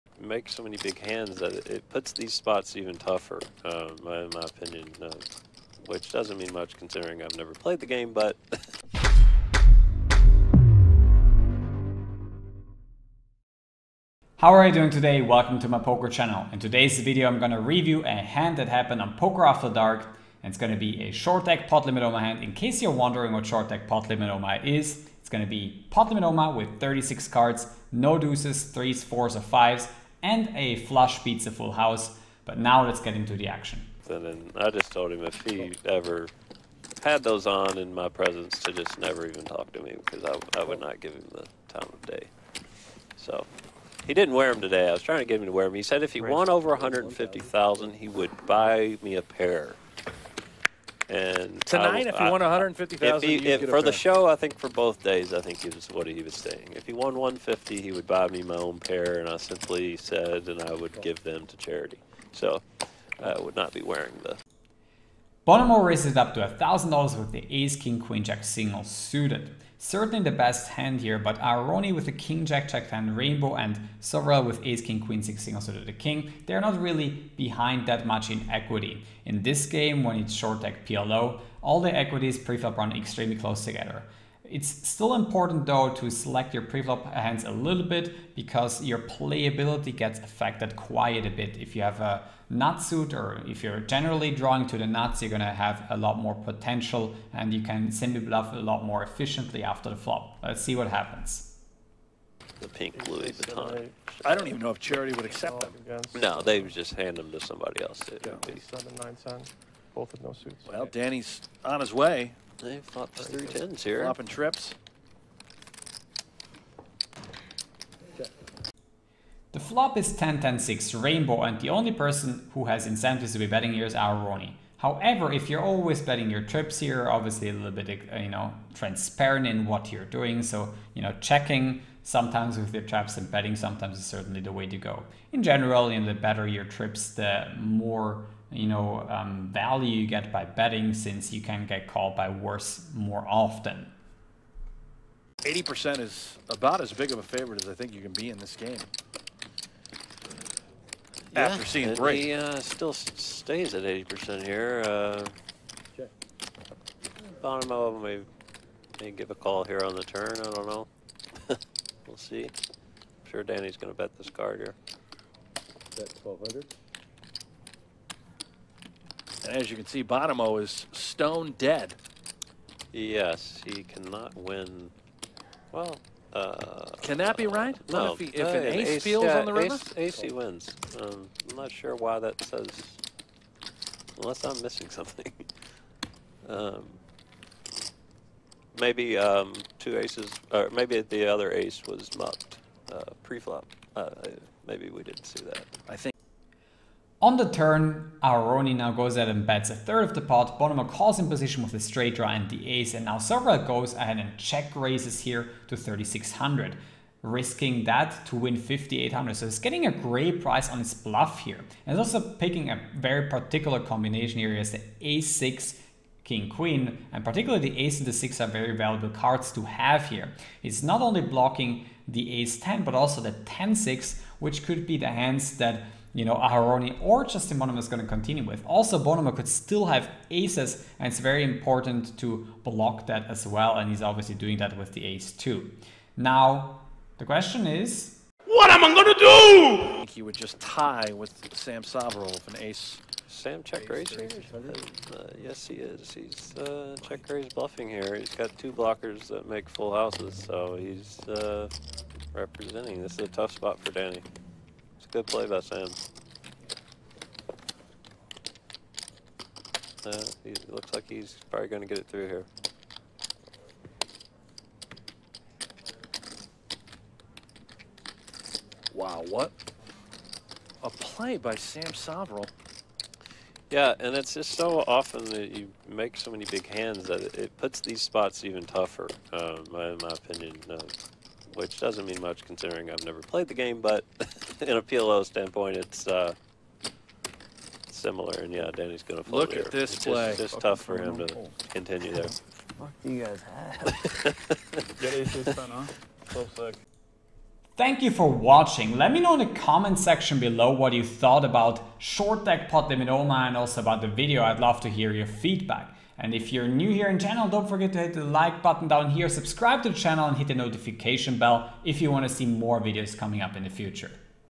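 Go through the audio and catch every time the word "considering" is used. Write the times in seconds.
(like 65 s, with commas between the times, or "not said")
6 s, 282 s.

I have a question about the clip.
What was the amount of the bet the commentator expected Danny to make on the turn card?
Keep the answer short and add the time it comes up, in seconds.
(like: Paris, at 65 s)
1200, at 166 s.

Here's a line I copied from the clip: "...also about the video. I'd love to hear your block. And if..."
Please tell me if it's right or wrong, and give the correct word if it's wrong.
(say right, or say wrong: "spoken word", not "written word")
wrong: "feedback", not "block".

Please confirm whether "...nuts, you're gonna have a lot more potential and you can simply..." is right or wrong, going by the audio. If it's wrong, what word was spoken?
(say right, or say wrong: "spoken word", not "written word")
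right.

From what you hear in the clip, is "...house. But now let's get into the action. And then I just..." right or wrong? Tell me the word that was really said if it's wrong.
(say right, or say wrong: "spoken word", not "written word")
right.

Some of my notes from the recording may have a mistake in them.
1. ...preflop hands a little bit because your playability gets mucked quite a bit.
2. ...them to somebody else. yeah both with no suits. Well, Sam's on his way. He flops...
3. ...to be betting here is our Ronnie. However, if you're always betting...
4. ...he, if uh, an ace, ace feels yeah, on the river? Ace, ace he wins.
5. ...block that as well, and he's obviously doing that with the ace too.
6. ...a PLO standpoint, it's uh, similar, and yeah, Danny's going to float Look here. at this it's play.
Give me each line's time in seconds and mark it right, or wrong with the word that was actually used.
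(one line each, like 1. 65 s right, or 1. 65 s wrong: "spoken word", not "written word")
1. 86 s wrong: "affected", not "mucked"
2. 107 s wrong: "Danny", not "Sam"
3. 123 s right
4. 178 s right
5. 232 s right
6. 284 s right.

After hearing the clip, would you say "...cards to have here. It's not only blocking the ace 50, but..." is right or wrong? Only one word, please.
wrong.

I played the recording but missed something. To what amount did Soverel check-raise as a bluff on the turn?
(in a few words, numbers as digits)
3600.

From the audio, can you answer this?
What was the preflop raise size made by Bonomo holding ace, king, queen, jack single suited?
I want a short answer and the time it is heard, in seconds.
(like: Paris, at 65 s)
$1,000, at 66 s.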